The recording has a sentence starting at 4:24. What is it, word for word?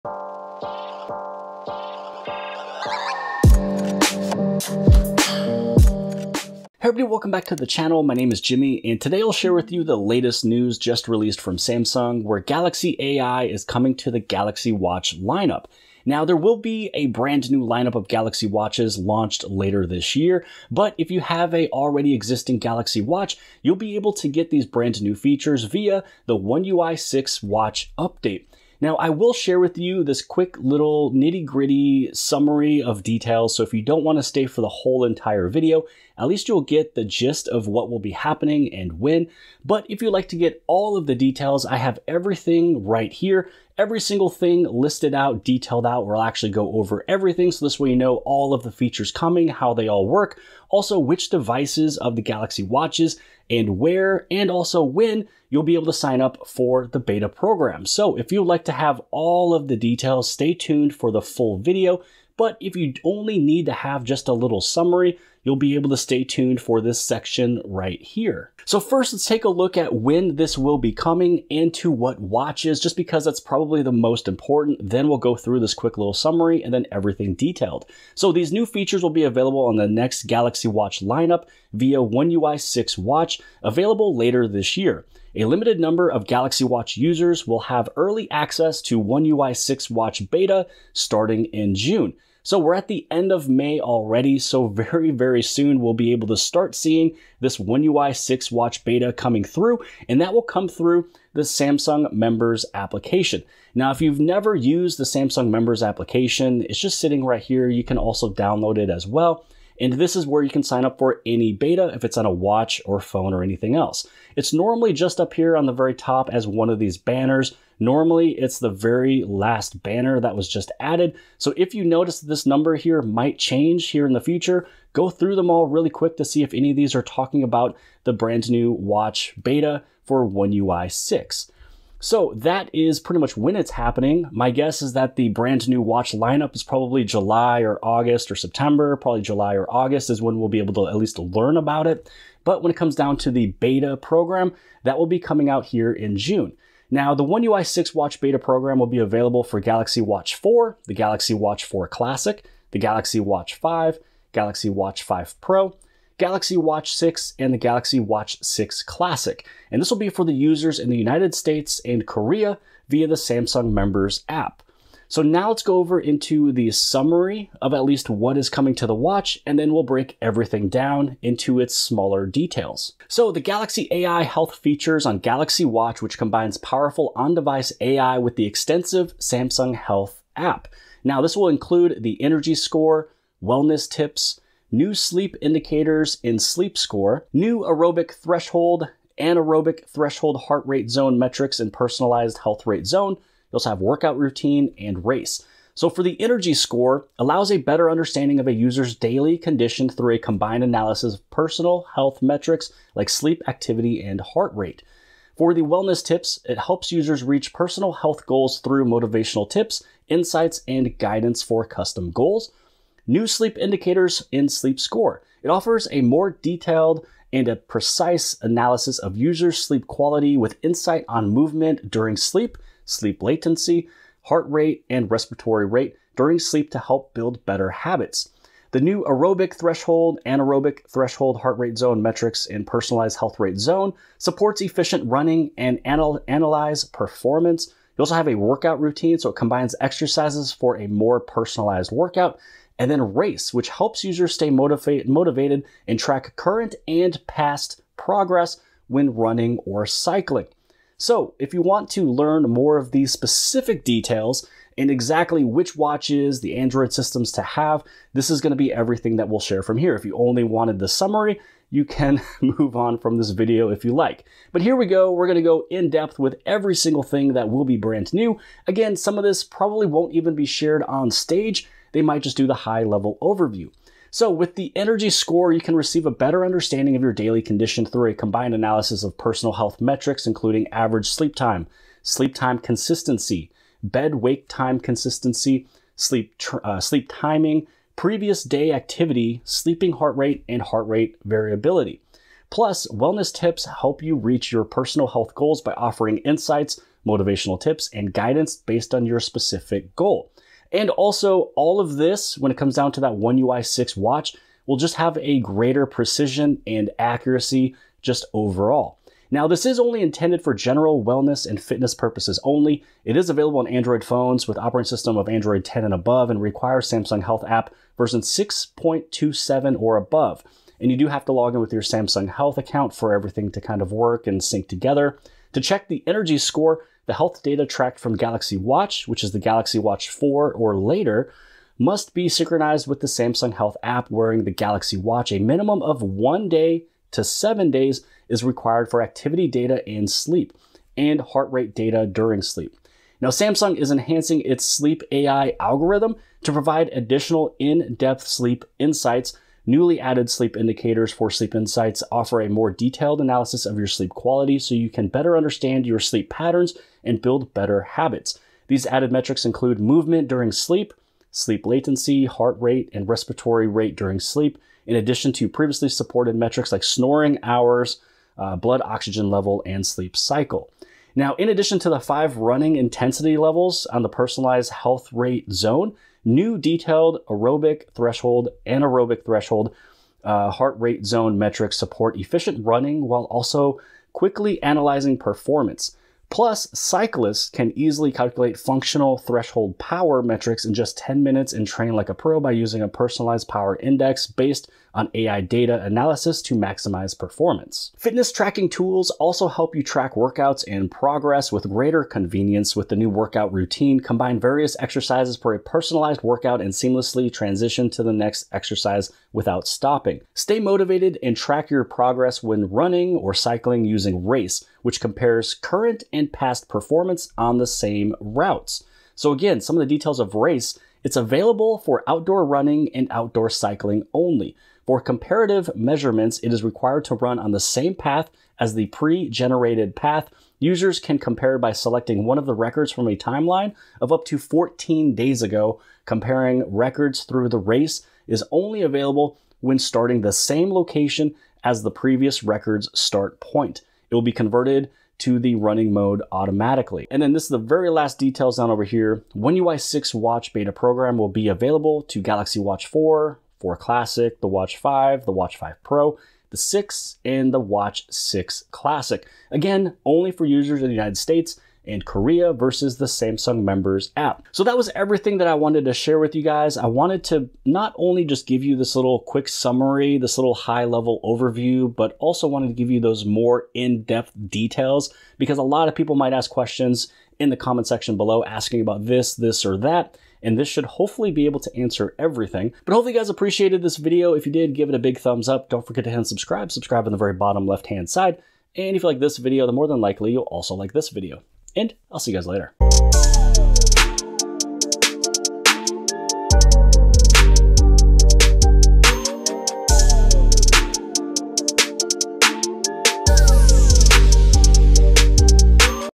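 But here we go, we're gonna go in depth with every single thing that will be brand new.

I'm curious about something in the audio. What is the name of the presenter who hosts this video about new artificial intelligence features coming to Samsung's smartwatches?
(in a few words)
Jimmy.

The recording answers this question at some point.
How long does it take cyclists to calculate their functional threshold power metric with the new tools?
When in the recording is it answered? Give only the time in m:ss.
6:30.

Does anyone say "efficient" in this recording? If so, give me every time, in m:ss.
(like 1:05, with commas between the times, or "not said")
3:54, 6:22.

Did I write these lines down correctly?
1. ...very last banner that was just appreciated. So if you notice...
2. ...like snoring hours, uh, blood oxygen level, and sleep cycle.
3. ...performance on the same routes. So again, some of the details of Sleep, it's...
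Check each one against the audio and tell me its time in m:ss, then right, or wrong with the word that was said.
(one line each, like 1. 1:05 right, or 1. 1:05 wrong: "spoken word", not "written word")
1. 1:58 wrong: "added", not "appreciated"
2. 6:06 right
3. 6:56 wrong: "Race", not "Sleep".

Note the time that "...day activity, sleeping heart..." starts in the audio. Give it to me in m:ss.
4:48.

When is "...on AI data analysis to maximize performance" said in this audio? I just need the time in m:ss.
6:34.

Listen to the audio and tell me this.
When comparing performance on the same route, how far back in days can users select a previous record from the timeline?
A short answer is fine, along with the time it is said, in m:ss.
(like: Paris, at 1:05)
14 days, at 7:14.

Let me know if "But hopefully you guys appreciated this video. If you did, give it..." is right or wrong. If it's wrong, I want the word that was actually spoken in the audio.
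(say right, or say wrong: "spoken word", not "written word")
right.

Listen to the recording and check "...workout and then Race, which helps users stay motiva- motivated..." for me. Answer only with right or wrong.
right.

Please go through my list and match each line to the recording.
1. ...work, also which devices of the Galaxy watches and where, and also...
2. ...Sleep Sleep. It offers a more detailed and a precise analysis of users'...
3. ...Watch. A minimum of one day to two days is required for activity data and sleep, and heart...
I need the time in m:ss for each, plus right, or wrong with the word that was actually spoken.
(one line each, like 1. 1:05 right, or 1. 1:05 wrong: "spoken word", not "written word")
1. 0:50 right
2. 3:34 wrong: "Score", not "Sleep"
3. 5:34 wrong: "seven", not "two".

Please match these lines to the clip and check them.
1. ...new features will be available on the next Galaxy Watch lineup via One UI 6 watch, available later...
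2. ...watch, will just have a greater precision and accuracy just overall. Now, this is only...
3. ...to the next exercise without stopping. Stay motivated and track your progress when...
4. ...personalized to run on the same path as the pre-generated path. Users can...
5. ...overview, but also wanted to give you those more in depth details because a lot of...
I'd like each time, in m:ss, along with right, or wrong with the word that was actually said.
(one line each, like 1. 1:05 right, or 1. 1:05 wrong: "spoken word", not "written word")
1. 1:18 right
2. 5:03 right
3. 6:47 right
4. 7:06 wrong: "required", not "personalized"
5. 7:51 right.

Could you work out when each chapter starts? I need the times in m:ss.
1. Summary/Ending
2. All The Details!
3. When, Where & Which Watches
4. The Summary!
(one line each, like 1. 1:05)
1. 7:44
2. 4:10
3. 1:08
4. 2:53.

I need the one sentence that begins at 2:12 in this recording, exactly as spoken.
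So that is pretty much when it's happening.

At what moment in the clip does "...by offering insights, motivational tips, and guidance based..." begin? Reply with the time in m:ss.
4:55.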